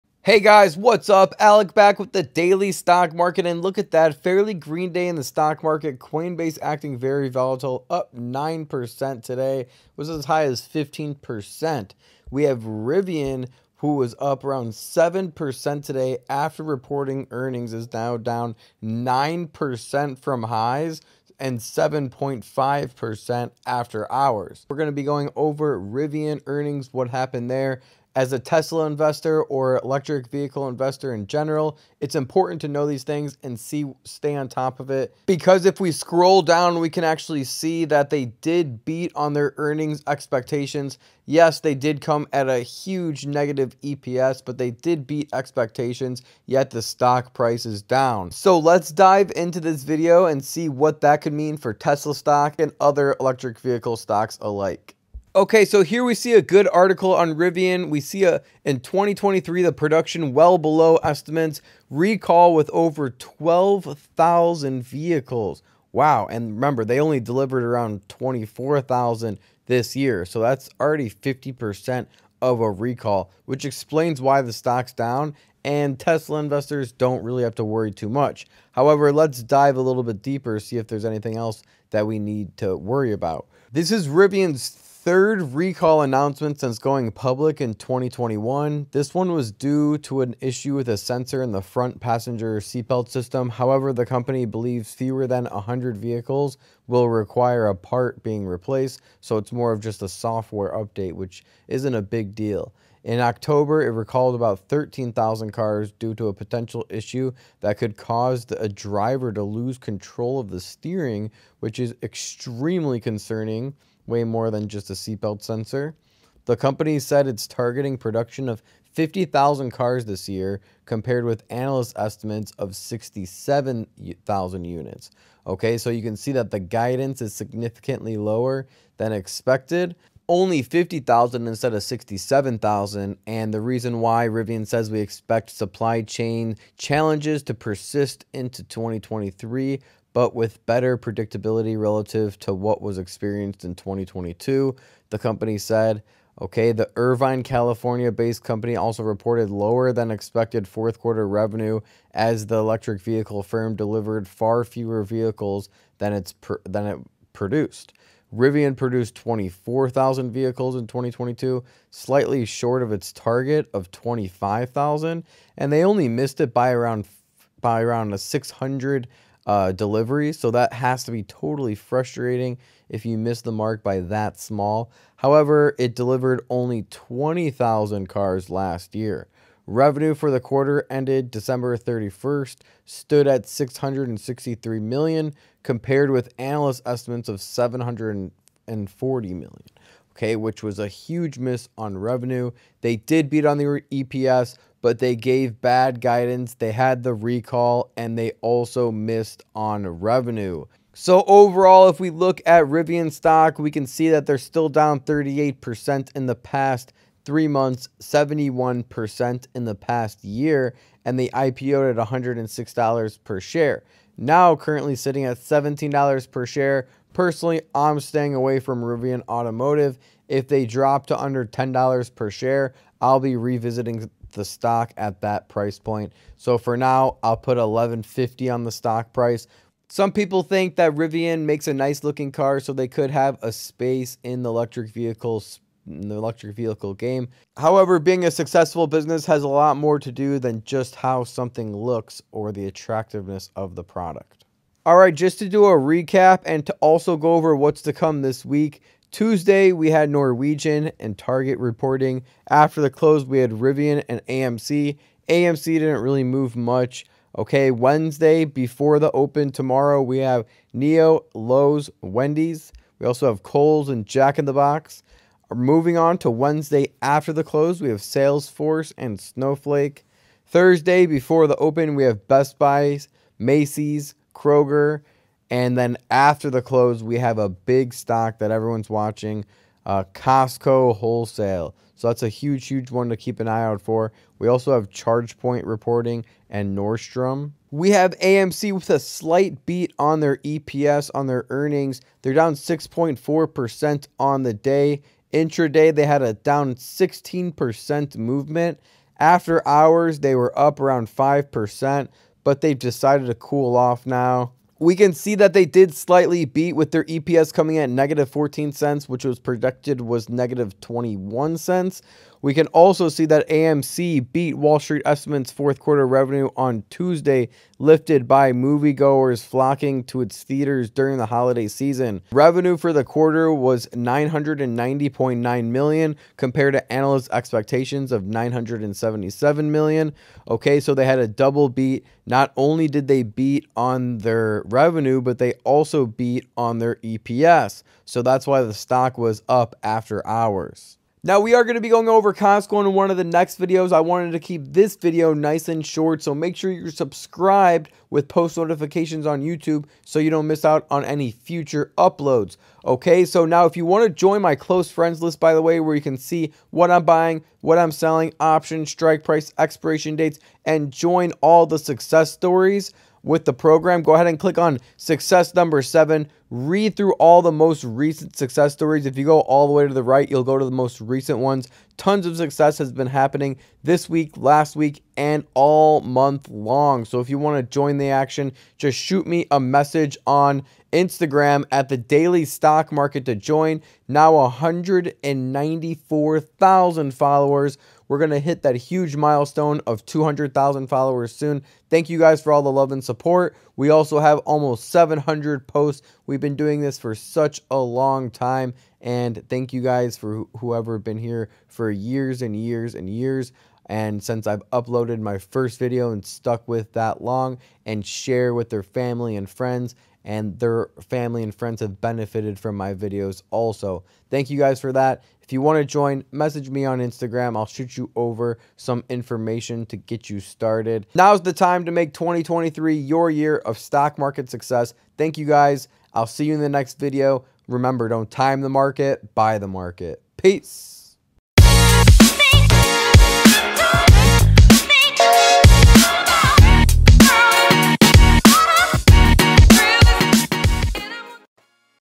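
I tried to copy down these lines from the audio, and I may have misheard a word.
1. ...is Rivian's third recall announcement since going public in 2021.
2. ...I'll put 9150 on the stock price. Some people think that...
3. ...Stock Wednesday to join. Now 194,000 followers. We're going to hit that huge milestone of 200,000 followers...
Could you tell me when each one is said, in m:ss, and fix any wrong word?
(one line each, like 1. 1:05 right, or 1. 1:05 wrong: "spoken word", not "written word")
1. 1:23 right
2. 3:47 wrong: "1150", not "9150"
3. 6:22 wrong: "Market", not "Wednesday".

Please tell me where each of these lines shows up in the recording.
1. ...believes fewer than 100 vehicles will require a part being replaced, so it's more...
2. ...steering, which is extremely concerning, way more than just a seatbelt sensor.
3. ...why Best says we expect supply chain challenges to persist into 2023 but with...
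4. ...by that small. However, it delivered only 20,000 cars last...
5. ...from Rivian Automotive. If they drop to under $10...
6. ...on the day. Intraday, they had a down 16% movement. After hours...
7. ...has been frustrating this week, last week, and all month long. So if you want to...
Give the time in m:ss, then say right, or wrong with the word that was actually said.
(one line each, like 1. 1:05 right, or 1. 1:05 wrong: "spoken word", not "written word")
1. 1:34 right
2. 1:50 right
3. 2:13 wrong: "Rivian", not "Best"
4. 2:53 right
5. 3:38 right
6. 4:54 right
7. 6:12 wrong: "happening", not "frustrating".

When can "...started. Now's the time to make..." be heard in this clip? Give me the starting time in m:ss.
7:00.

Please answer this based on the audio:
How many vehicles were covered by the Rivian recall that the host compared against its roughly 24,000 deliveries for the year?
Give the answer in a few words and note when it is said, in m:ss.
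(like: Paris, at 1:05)
over 12,000, at 1:02.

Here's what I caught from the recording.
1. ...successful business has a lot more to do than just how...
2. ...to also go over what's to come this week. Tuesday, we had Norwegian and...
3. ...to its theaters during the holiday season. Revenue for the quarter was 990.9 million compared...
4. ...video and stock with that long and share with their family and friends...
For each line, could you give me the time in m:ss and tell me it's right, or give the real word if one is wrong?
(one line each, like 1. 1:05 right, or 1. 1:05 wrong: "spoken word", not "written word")
1. 3:58 right
2. 4:06 right
3. 5:20 right
4. 6:45 wrong: "stuck", not "stock".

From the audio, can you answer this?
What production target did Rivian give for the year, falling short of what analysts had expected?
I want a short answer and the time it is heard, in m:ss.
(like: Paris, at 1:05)
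50,000, at 1:58.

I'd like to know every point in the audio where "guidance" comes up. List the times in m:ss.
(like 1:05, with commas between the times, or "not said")
2:06, 3:16.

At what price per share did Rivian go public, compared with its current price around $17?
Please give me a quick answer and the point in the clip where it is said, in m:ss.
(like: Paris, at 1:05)
$106, at 3:32.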